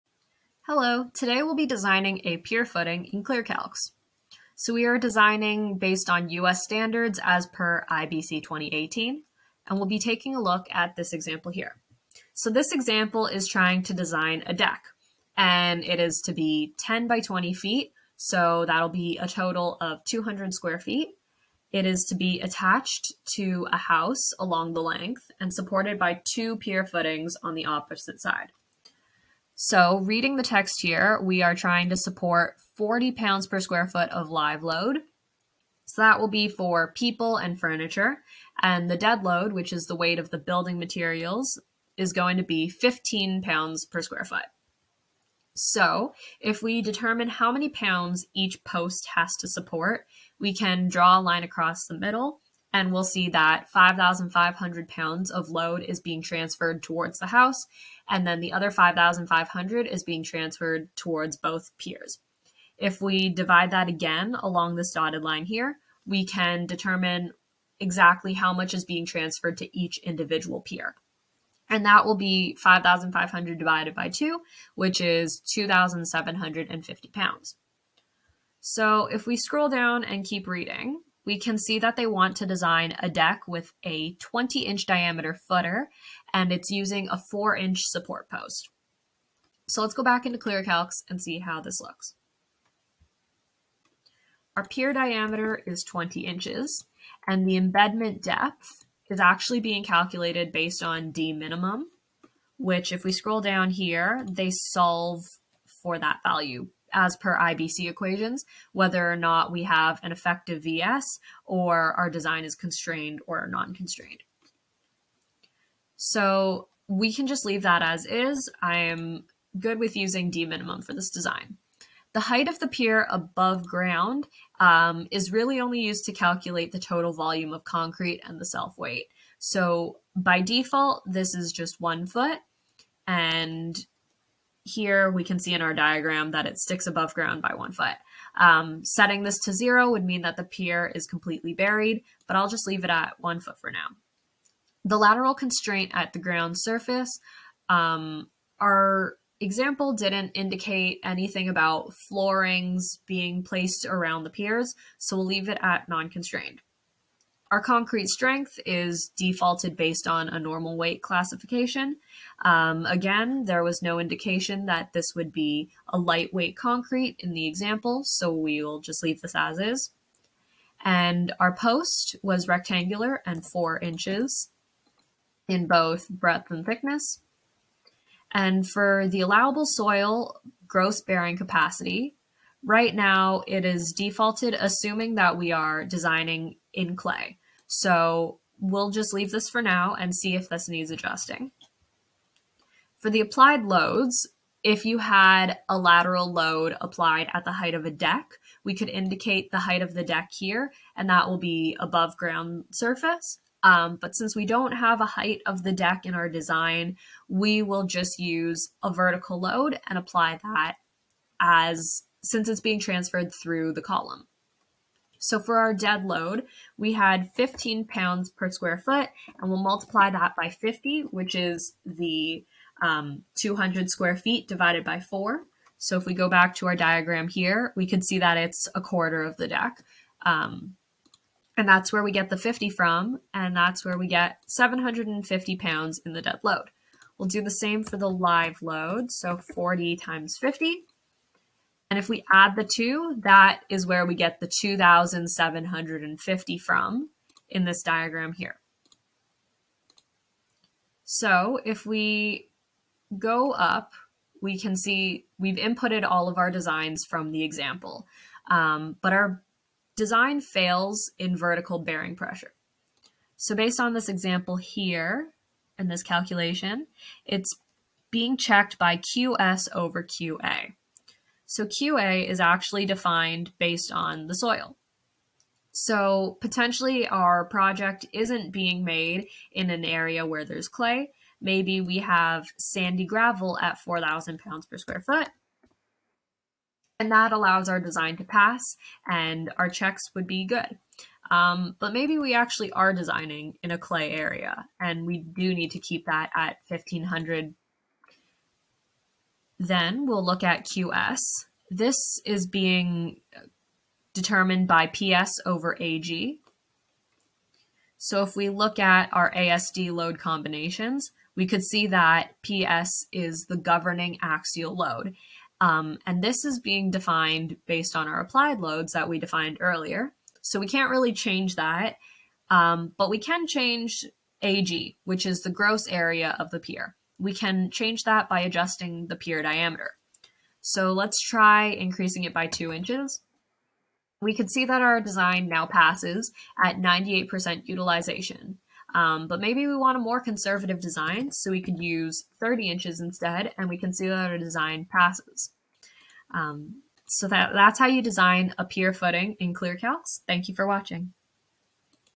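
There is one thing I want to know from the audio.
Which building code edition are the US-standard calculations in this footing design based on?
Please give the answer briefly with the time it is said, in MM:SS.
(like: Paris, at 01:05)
IBC 2018, at 00:07.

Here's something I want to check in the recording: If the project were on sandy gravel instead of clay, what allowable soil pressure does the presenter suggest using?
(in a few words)
4,000 pounds per square foot.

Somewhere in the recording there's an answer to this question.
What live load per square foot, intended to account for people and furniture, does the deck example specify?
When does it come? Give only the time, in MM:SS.
00:32.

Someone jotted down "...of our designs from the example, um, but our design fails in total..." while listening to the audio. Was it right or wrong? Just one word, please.
wrong.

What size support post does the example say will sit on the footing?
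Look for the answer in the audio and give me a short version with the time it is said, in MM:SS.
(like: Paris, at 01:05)
4 inch, at 01:27.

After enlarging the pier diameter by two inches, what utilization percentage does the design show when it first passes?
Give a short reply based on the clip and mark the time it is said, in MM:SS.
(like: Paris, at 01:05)
98%, at 05:36.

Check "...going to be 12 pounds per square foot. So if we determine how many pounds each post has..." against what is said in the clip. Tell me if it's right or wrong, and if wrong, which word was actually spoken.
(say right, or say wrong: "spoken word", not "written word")
wrong: "15", not "12".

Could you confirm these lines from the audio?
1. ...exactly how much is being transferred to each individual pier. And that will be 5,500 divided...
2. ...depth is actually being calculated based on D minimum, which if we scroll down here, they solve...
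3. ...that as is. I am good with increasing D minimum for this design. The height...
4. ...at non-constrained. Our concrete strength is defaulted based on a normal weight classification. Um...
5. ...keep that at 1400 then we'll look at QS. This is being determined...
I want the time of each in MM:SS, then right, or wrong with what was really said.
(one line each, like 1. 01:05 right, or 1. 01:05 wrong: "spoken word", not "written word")
1. 01:07 right
2. 01:38 right
3. 01:57 wrong: "using", not "increasing"
4. 02:35 right
5. 04:55 wrong: "1500", not "1400".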